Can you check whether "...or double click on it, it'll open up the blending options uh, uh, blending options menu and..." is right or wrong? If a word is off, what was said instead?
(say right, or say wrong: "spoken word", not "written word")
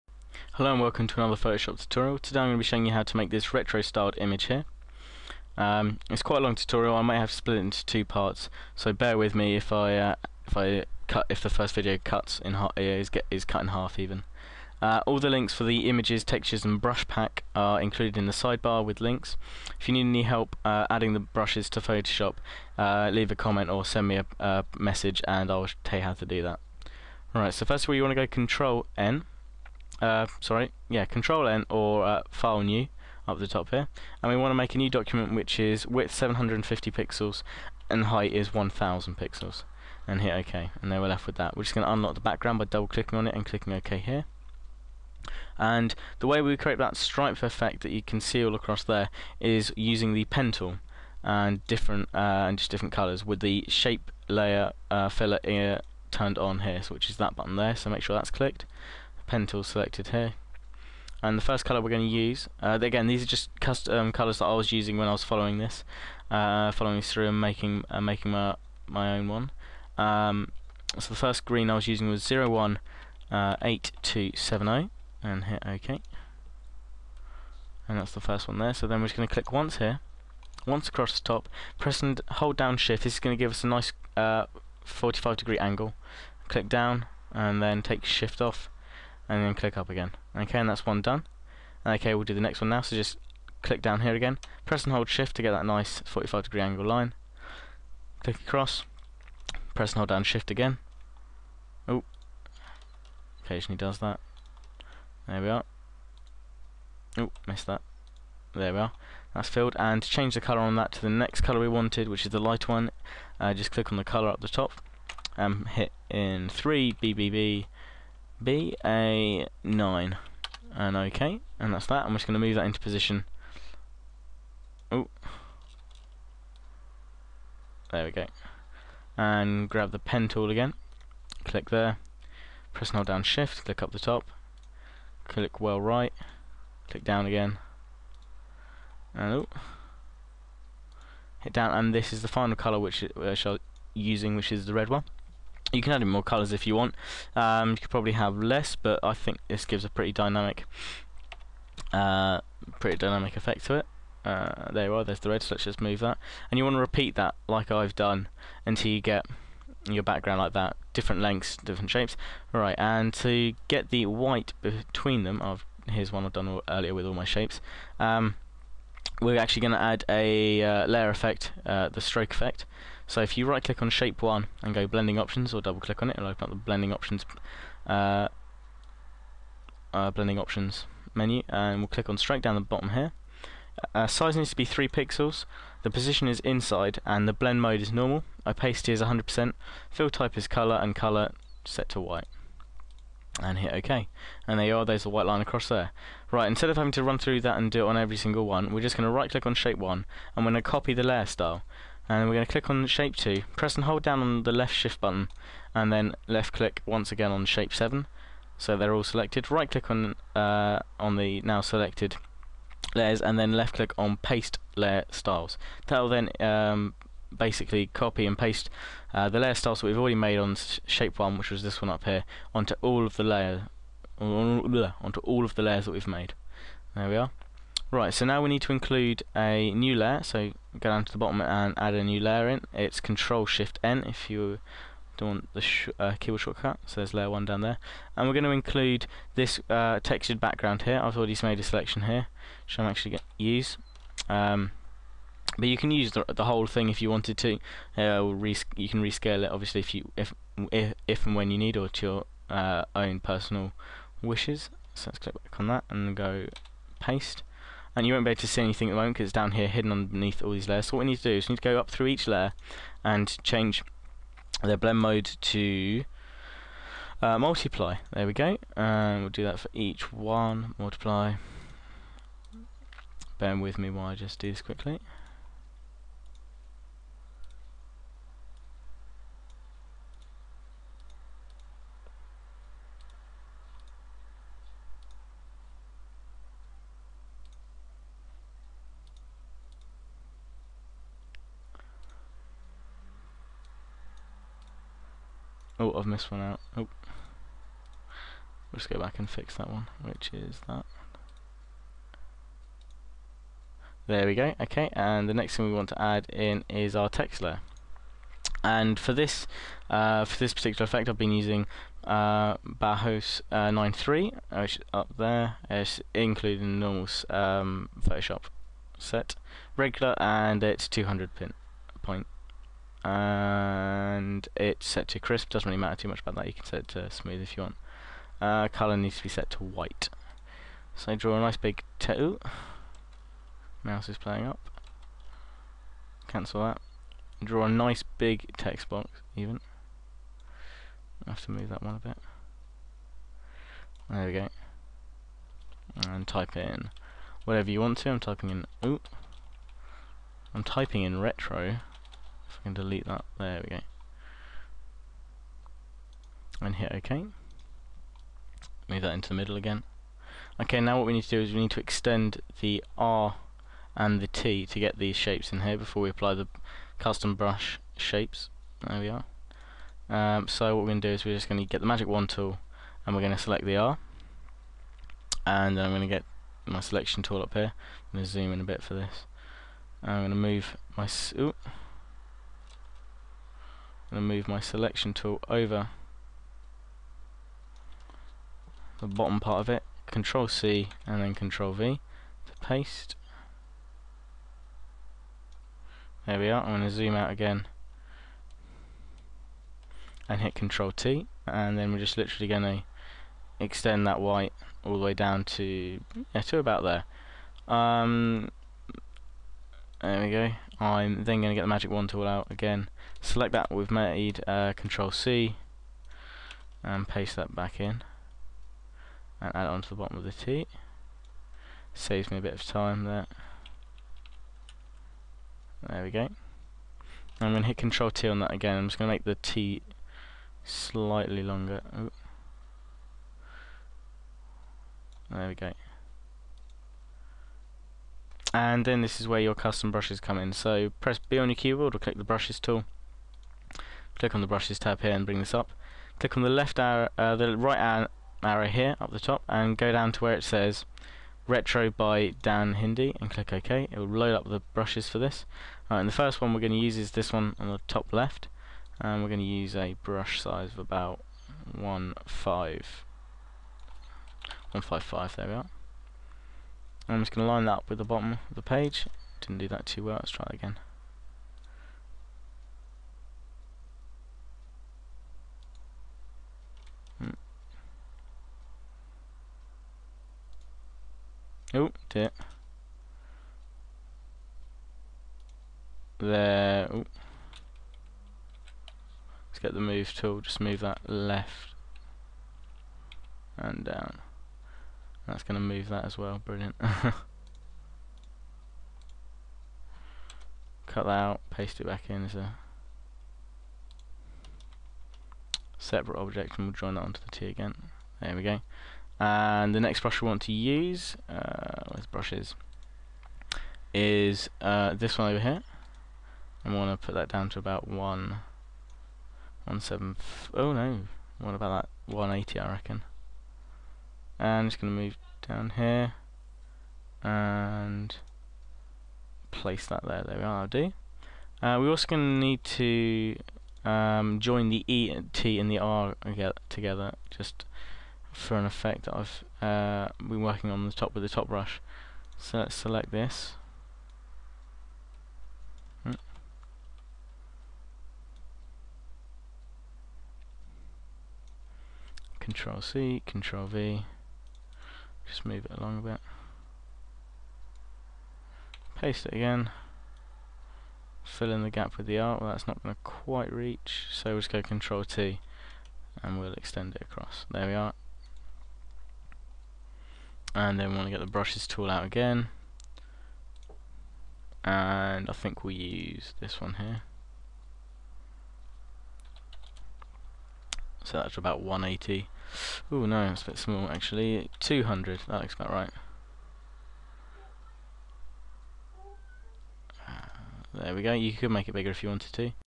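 right.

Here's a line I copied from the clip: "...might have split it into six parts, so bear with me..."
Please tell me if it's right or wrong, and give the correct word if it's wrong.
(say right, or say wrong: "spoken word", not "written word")
wrong: "two", not "six".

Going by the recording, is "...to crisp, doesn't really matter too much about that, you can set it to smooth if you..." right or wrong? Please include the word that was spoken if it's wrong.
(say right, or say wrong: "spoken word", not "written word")
right.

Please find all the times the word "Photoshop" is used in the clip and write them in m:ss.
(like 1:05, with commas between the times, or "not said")
0:01, 0:21, 5:17.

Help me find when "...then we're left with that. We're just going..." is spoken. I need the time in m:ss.
0:40.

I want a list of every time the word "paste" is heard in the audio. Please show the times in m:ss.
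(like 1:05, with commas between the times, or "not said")
3:34, 3:38, 4:16, 6:32, 6:57, 8:21, 9:18.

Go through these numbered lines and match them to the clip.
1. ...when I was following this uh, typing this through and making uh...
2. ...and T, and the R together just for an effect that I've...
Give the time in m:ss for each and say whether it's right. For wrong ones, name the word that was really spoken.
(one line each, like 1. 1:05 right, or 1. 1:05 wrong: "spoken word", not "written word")
1. 1:04 wrong: "following", not "typing"
2. 8:55 right.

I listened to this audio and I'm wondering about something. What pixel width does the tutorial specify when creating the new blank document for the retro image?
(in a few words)
750 pixels.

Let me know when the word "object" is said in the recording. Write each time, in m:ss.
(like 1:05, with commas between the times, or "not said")
8:26.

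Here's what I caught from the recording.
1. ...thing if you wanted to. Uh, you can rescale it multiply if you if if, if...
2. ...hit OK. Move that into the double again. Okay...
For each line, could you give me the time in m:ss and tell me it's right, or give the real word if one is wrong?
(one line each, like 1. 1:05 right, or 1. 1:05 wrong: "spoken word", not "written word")
1. 4:06 wrong: "obviously", not "multiply"
2. 5:56 wrong: "middle", not "double".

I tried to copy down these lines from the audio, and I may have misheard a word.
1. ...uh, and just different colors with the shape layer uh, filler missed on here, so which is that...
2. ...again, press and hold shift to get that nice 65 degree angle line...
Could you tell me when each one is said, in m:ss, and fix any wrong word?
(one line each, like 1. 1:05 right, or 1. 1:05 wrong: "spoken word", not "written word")
1. 0:52 wrong: "turned", not "missed"
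2. 1:34 wrong: "45", not "65".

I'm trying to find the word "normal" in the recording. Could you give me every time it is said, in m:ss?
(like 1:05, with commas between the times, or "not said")
3:07, 5:16.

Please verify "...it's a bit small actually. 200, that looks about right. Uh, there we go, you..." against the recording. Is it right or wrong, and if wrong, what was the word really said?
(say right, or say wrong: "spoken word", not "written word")
right.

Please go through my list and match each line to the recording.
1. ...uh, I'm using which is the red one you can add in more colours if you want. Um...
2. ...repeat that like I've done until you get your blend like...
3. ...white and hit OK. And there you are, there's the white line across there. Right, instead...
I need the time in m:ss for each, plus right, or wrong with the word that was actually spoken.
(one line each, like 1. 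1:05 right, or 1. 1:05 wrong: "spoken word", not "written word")
1. 2:23 right
2. 2:36 wrong: "background", not "blend"
3. 3:12 right.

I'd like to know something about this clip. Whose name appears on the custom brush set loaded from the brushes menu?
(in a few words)
Dan Hindi.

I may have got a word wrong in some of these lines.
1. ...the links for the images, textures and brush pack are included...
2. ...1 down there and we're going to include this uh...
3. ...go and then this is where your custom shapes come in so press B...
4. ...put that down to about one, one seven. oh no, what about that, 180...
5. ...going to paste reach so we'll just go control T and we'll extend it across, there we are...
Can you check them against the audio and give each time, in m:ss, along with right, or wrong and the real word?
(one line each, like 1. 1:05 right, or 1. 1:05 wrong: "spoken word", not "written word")
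1. 0:15 right
2. 3:57 right
3. 7:15 wrong: "brushes", not "shapes"
4. 8:37 right
5. 9:22 wrong: "quite", not "paste".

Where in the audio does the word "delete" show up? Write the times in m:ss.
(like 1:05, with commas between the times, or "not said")
5:52.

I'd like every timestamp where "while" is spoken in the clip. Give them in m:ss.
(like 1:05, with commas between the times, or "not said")
4:33.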